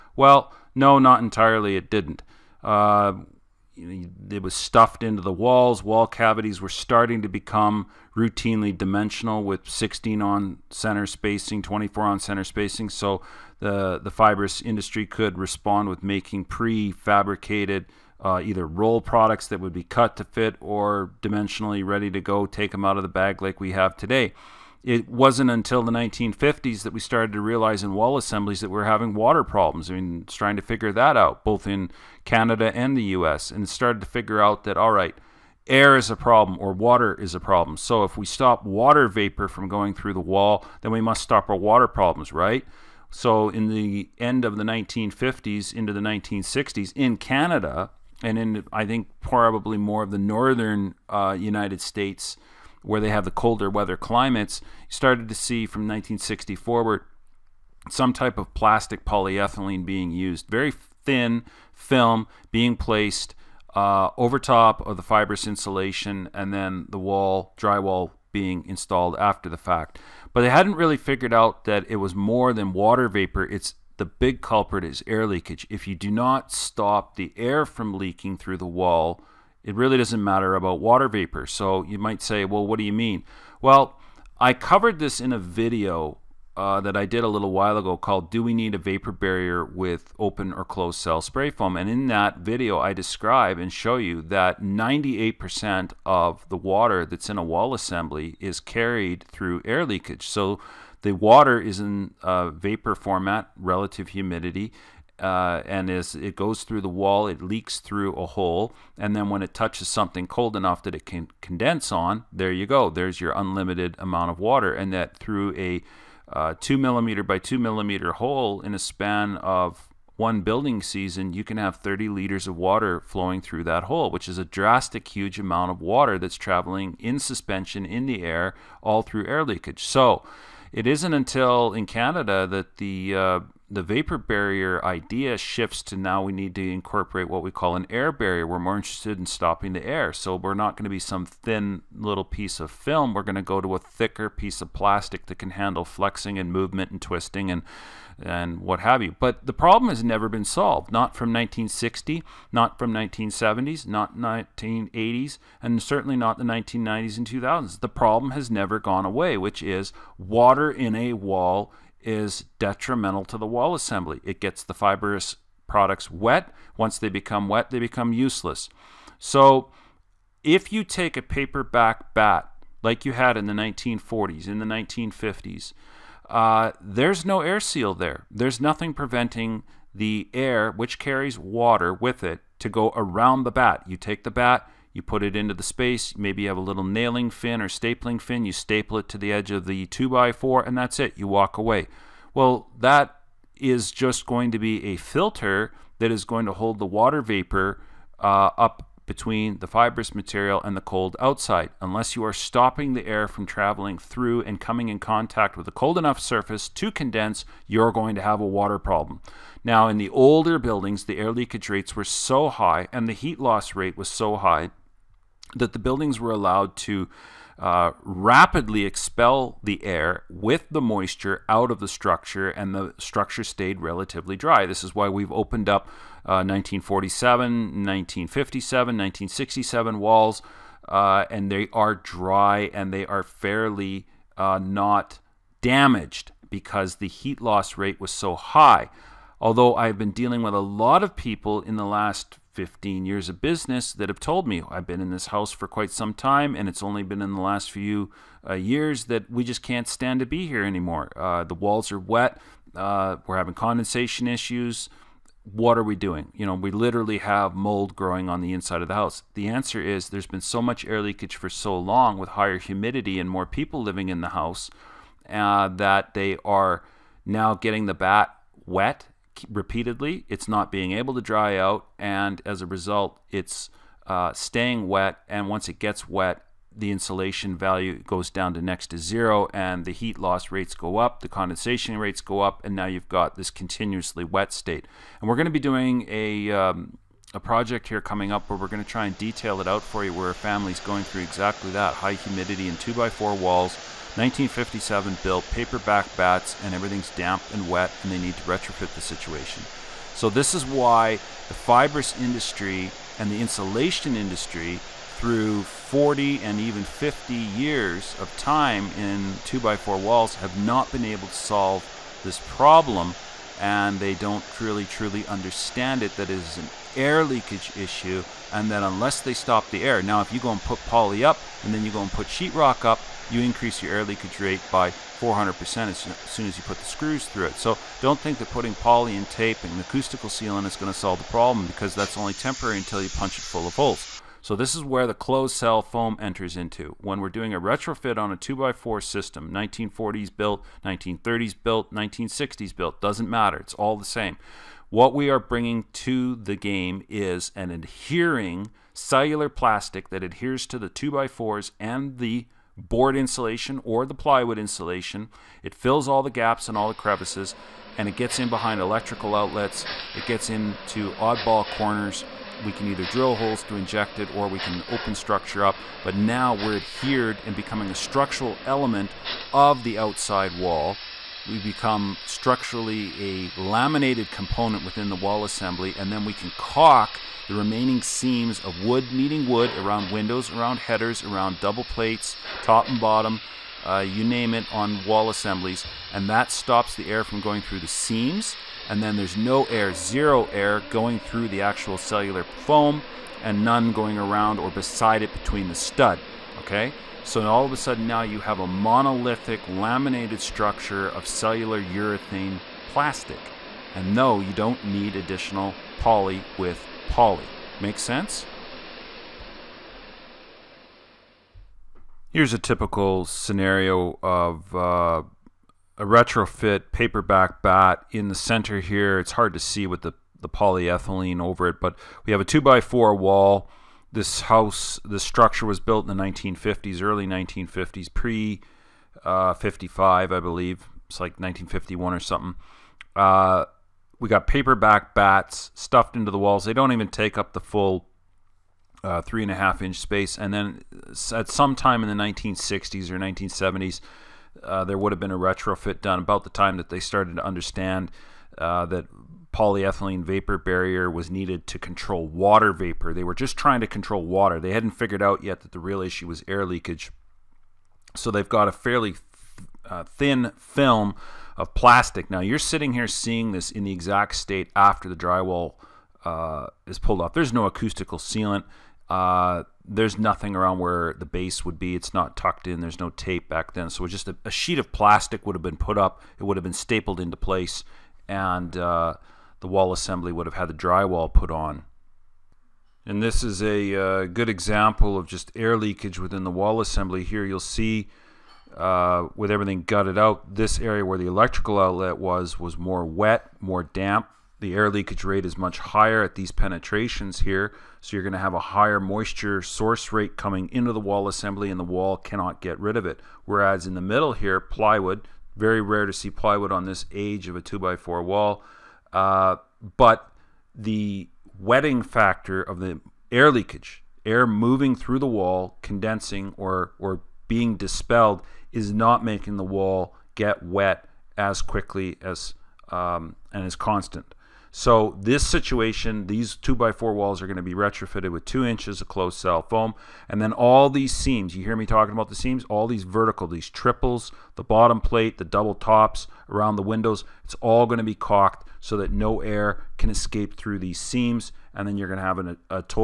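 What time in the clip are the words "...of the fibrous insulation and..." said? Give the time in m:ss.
1:04.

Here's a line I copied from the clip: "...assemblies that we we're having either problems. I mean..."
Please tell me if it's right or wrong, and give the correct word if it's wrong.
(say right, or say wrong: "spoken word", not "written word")
wrong: "water", not "either".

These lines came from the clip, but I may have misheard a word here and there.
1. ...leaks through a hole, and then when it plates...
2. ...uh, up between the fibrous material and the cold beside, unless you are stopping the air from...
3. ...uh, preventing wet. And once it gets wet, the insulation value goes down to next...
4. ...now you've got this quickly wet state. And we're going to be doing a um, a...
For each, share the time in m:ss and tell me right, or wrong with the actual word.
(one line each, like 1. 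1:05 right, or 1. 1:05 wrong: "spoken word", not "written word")
1. 1:47 wrong: "touches", not "plates"
2. 3:18 wrong: "outside", not "beside"
3. 4:34 wrong: "staying", not "preventing"
4. 4:42 wrong: "continuously", not "quickly".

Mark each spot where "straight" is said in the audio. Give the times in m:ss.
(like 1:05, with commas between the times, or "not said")
not said.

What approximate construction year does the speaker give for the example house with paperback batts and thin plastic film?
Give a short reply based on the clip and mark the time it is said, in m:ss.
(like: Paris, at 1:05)
1951, at 7:11.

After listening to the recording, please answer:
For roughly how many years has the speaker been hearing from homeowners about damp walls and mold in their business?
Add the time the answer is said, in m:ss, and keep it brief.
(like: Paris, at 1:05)
15 years, at 4:02.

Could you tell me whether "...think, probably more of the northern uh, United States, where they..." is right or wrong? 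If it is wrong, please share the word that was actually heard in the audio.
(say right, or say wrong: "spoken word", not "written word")
right.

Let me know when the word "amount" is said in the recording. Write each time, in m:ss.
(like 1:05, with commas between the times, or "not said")
1:53, 2:05.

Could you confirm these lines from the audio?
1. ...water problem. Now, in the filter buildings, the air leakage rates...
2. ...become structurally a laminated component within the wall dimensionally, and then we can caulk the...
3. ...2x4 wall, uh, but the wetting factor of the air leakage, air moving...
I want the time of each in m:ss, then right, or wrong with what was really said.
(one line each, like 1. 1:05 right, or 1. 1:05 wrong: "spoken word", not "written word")
1. 3:28 wrong: "older", not "filter"
2. 6:11 wrong: "assembly", not "dimensionally"
3. 8:27 right.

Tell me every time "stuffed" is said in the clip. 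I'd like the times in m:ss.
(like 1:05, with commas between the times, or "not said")
0:04, 7:15.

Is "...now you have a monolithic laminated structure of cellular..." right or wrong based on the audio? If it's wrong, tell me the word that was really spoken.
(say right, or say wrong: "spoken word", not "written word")
right.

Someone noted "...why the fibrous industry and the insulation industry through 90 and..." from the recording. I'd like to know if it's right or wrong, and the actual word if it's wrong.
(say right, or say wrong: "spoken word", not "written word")
wrong: "40", not "90".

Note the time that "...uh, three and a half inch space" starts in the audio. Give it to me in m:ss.
7:19.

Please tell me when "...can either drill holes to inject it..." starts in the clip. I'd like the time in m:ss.
6:02.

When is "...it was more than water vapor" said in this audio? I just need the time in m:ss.
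1:11.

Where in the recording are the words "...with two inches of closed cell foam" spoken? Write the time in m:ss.
8:48.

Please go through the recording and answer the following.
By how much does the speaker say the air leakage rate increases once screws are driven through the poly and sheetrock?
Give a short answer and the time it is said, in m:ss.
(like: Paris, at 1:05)
400%, at 5:24.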